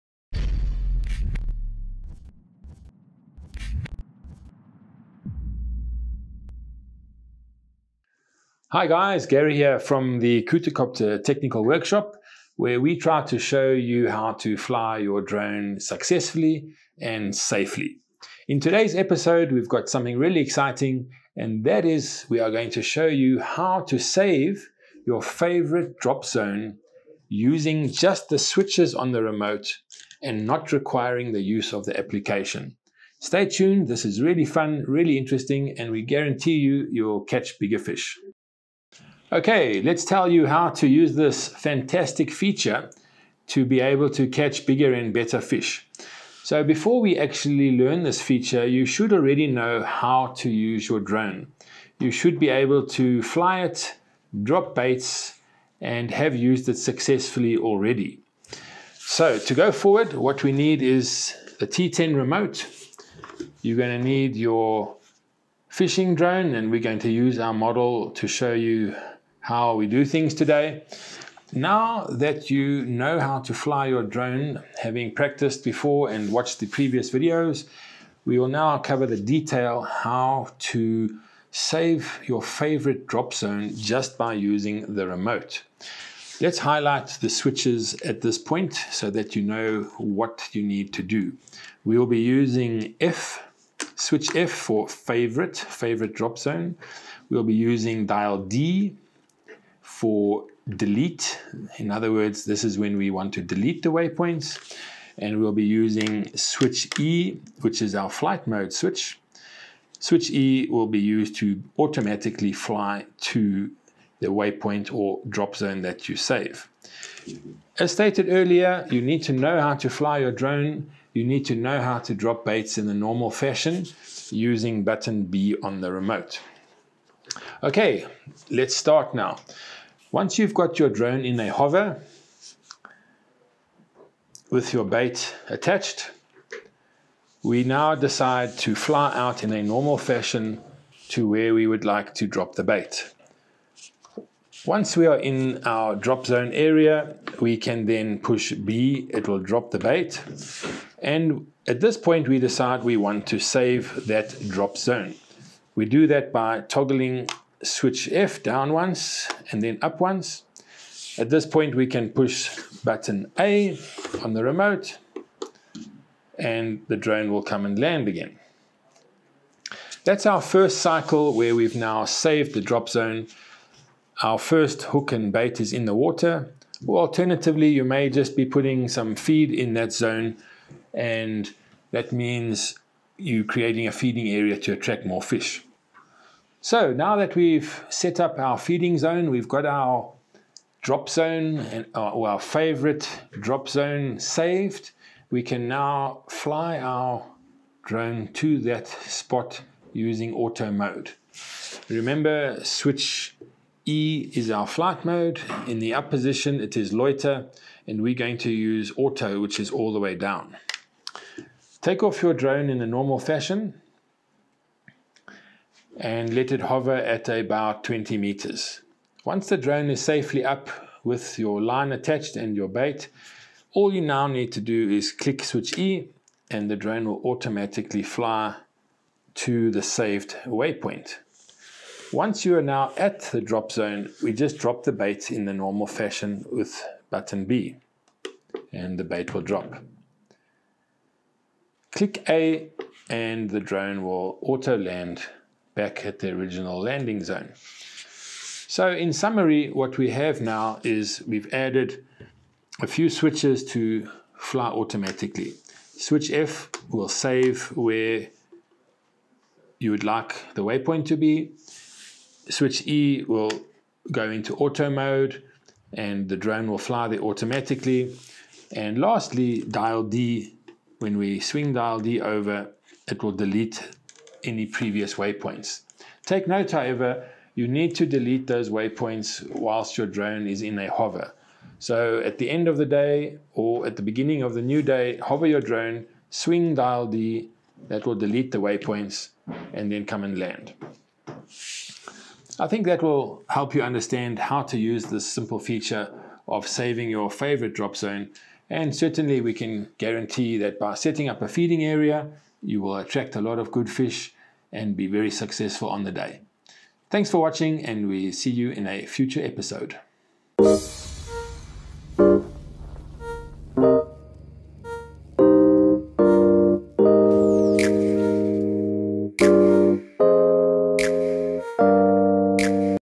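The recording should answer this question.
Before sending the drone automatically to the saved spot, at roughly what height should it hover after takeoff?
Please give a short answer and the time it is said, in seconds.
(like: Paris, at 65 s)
20 meters, at 217 s.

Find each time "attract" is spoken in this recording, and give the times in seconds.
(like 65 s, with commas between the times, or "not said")
184 s, 302 s.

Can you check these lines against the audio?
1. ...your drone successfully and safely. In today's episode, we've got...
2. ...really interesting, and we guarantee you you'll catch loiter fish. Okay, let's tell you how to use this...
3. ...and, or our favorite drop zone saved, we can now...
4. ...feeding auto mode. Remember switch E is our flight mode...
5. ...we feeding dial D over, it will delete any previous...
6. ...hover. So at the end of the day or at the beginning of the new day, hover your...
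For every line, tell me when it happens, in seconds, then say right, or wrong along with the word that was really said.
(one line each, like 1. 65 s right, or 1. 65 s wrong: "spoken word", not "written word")
1. 14 s right
2. 34 s wrong: "bigger", not "loiter"
3. 191 s right
4. 199 s wrong: "using", not "feeding"
5. 271 s wrong: "swing", not "feeding"
6. 280 s right.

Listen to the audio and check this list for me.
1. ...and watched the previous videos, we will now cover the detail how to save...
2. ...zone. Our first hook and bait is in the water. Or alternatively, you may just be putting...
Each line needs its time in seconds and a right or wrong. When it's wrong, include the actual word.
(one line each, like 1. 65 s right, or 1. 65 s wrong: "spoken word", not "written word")
1. 76 s right
2. 172 s right.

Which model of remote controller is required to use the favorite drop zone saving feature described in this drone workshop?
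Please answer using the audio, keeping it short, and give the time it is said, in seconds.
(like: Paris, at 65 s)
T10, at 61 s.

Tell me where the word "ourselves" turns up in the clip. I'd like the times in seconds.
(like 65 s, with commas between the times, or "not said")
not said.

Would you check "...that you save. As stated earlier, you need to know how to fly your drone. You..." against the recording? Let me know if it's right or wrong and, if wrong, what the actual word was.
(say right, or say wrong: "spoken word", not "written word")
right.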